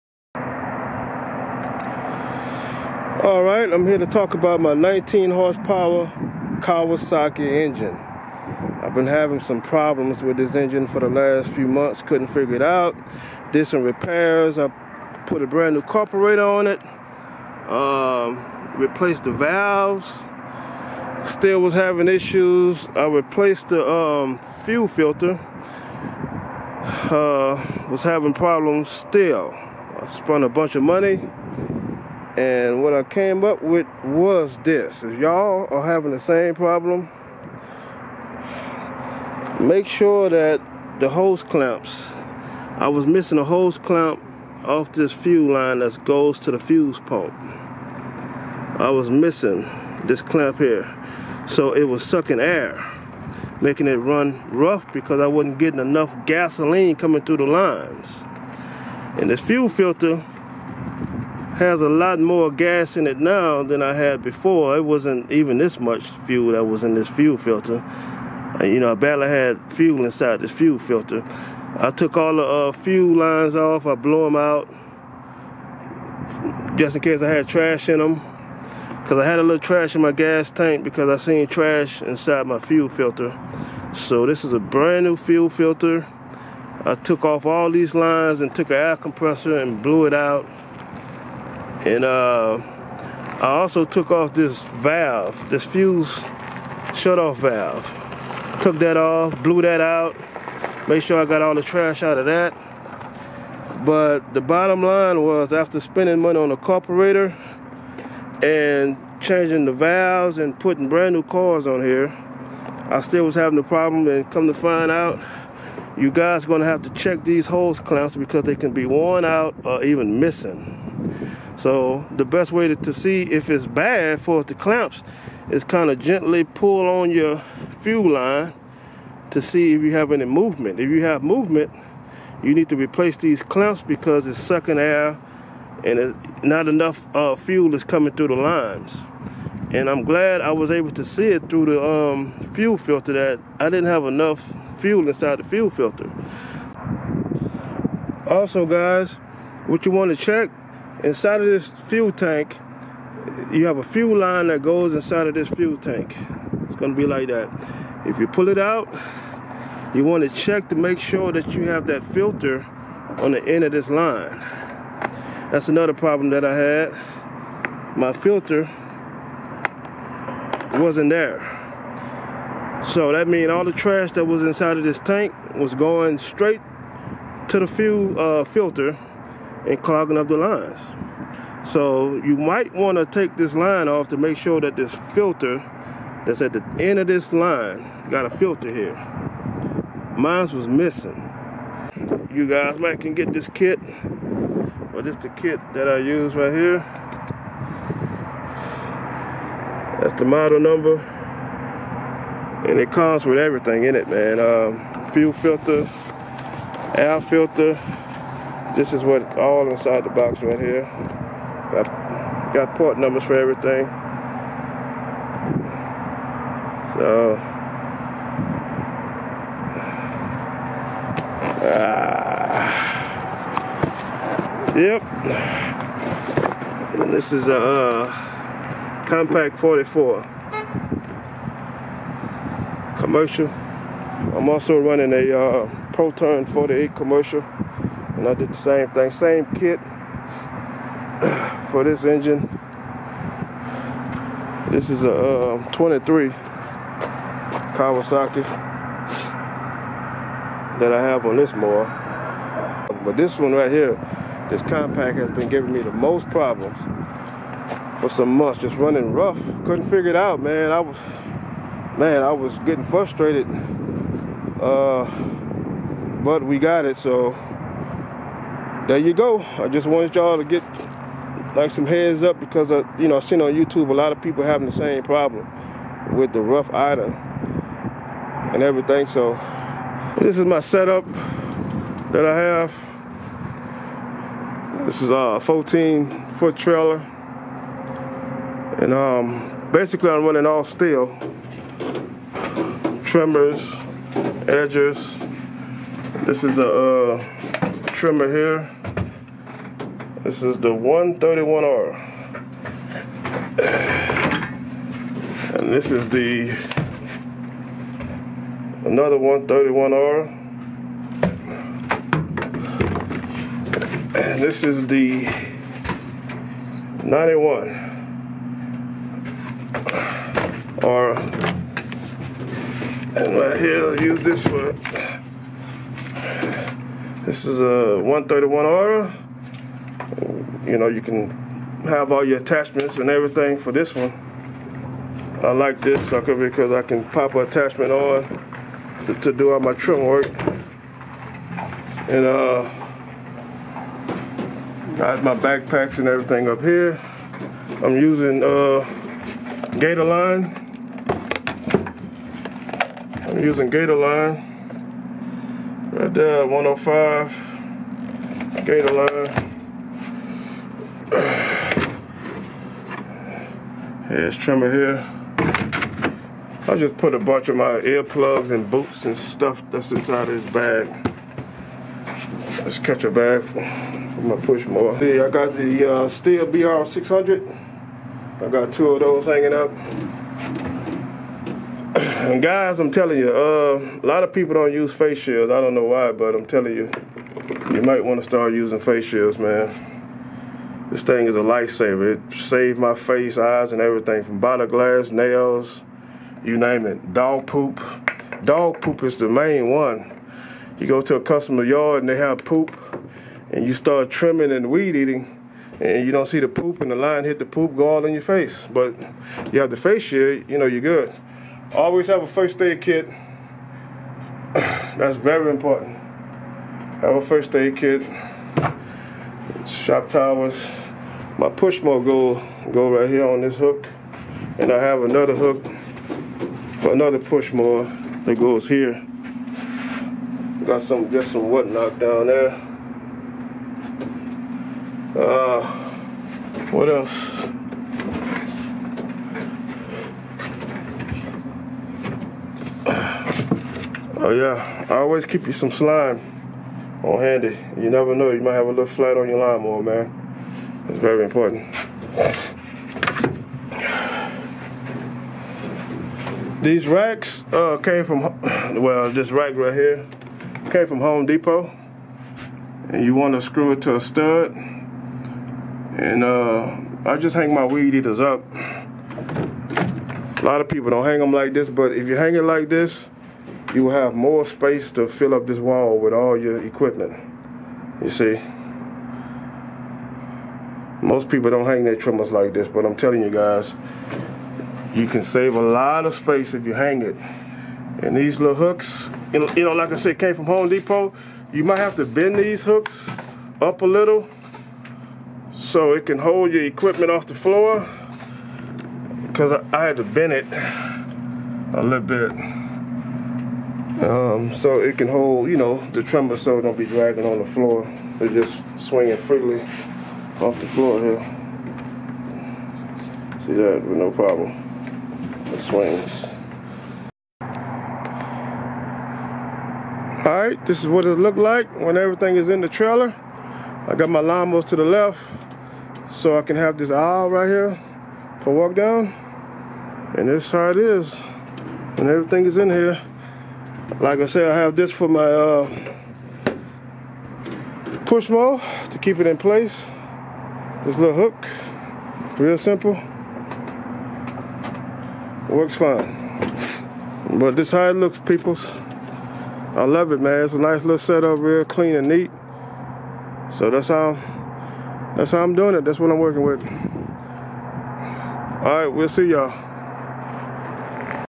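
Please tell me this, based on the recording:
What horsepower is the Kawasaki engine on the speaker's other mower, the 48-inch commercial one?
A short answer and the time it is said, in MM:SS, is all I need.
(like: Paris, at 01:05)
23, at 04:05.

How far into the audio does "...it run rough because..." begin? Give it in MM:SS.
00:53.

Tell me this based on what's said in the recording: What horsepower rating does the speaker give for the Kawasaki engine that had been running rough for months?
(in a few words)
19.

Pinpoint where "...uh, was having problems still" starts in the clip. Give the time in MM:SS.
00:27.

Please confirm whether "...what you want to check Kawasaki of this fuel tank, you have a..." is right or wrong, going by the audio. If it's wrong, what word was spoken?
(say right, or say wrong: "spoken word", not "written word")
wrong: "Inside", not "Kawasaki".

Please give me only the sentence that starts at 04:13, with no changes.
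But this one right here, this compact has been giving me the most problems for some months, just running rough.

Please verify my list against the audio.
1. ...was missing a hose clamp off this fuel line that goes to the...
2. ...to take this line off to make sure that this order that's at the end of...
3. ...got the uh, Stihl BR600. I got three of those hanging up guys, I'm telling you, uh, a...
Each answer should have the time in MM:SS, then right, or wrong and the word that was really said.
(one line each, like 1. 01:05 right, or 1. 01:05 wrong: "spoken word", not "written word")
1. 00:42 right
2. 03:02 wrong: "filter", not "order"
3. 06:15 wrong: "two", not "three".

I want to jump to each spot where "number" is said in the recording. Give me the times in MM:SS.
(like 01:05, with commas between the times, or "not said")
03:20, 03:32.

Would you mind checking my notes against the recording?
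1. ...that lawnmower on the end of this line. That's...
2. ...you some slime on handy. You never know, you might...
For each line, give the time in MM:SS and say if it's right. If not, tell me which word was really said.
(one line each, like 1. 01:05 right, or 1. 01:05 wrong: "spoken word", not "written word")
1. 02:41 wrong: "filter", not "lawnmower"
2. 07:25 right.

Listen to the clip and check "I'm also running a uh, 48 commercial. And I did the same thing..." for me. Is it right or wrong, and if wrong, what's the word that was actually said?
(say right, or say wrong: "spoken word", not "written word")
right.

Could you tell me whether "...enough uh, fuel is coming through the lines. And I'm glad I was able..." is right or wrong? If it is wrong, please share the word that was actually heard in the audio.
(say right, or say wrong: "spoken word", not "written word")
right.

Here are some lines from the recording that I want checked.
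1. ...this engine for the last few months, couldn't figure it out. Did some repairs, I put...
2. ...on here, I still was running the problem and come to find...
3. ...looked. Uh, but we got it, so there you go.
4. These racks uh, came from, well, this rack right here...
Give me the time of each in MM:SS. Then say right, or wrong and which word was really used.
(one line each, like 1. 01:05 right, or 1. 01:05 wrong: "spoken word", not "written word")
1. 00:10 right
2. 01:51 wrong: "having", not "running"
3. 04:22 wrong: "frustrated", not "looked"
4. 07:36 right.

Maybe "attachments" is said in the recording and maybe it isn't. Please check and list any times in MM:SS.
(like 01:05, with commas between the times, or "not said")
05:32, 05:37.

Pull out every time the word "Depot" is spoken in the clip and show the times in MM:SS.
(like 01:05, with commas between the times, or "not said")
07:41, 08:10.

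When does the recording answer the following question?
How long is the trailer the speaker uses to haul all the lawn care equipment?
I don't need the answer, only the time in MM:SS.
04:45.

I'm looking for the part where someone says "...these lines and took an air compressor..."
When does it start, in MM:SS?
01:27.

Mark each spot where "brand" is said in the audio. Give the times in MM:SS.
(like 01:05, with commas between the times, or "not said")
00:15, 01:24, 01:50.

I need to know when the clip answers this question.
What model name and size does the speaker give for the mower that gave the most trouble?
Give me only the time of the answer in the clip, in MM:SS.
03:49.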